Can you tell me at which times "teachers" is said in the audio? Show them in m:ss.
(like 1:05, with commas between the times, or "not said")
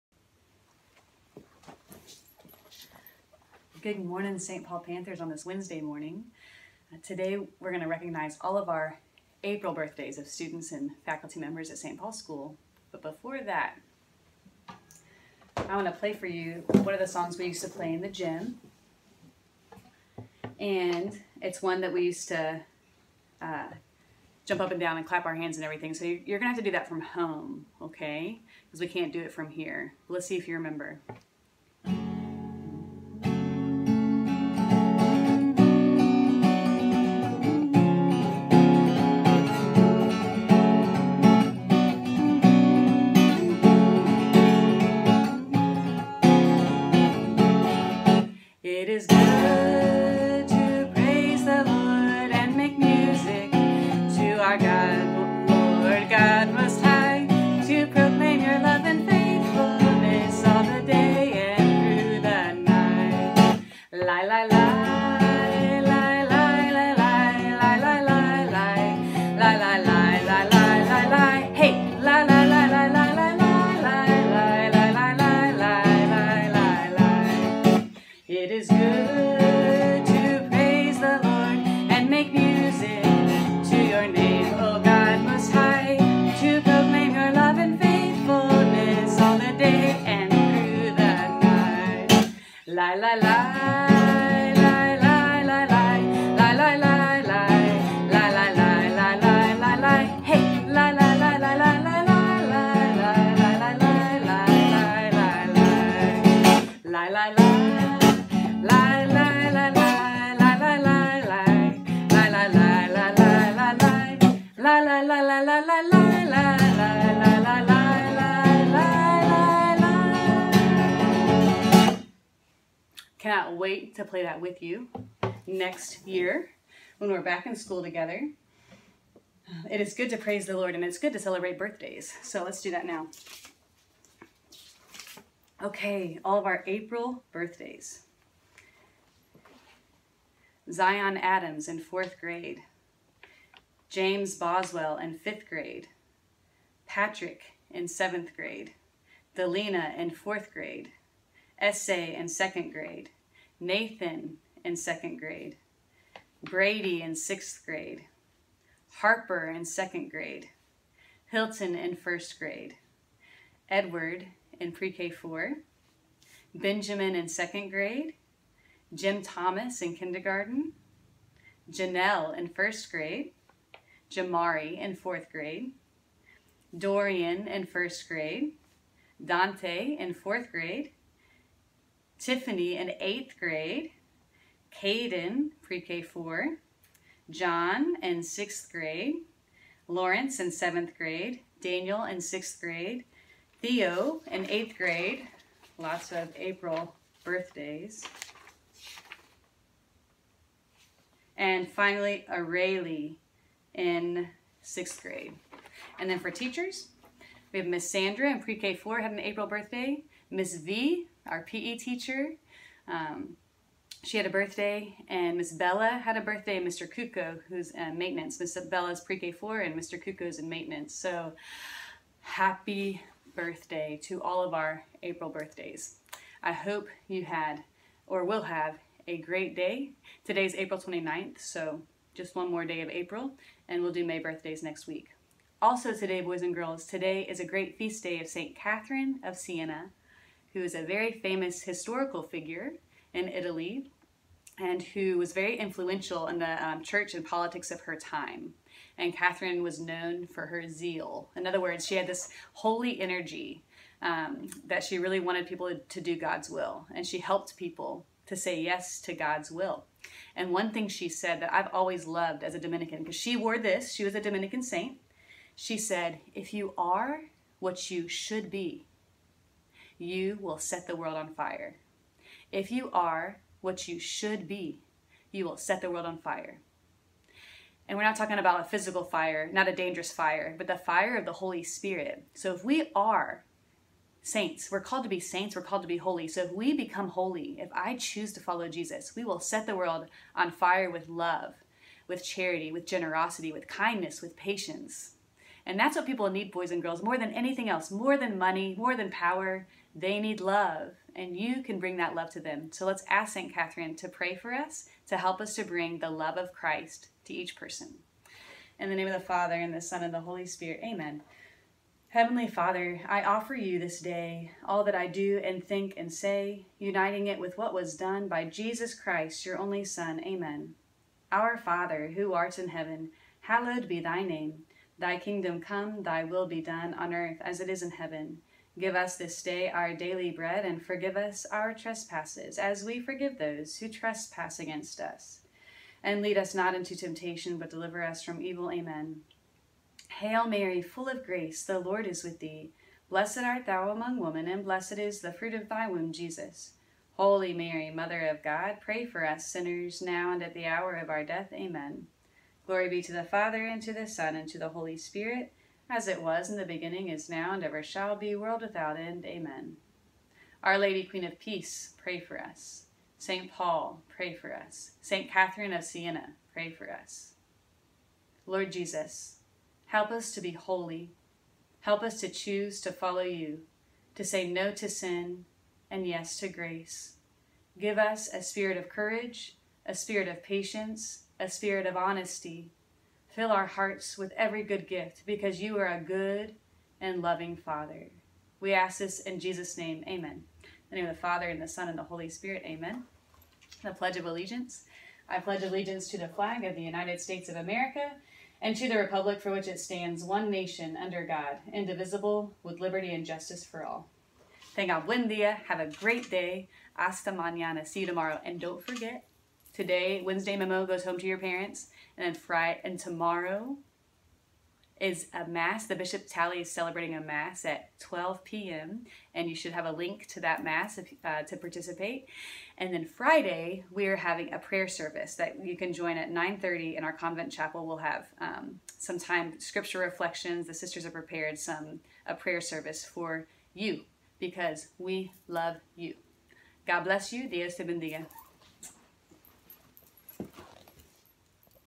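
3:26, 3:31.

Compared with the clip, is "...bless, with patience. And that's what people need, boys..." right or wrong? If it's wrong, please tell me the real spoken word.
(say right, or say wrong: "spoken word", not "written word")
wrong: "kindness", not "bless".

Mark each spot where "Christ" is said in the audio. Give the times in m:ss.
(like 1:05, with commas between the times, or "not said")
5:06, 5:18.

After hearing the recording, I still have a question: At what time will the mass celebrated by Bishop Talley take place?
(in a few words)
12 p.m.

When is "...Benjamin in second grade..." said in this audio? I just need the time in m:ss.
2:46.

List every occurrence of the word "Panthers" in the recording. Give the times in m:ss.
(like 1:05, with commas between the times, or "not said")
0:04.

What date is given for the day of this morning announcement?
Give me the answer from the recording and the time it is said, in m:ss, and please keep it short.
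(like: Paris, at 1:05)
April 29, at 3:50.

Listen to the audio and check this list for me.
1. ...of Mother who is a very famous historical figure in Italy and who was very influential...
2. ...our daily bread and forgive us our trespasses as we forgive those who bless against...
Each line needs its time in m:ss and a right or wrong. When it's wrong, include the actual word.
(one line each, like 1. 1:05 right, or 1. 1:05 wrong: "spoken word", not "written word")
1. 3:59 wrong: "Siena", not "Mother"
2. 5:29 wrong: "trespass", not "bless".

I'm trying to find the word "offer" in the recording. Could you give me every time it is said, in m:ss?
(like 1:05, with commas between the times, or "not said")
5:13.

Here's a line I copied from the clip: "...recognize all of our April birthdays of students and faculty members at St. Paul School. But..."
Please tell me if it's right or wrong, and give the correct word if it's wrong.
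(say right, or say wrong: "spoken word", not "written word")
right.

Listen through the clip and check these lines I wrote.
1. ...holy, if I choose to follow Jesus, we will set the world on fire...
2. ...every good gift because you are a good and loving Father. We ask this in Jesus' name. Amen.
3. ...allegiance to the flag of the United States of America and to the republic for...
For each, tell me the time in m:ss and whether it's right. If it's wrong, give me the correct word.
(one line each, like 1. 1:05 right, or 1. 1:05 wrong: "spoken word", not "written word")
1. 4:47 right
2. 6:24 right
3. 6:35 right.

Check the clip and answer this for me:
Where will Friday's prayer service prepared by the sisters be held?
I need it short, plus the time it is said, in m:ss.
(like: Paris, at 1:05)
Convent chapel, at 7:07.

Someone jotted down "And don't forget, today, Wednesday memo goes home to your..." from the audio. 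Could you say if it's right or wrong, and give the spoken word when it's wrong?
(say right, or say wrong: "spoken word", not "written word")
right.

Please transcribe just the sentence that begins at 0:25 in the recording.
So you're going to have to do that from home, okay?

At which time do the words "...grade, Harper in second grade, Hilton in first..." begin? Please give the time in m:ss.
2:37.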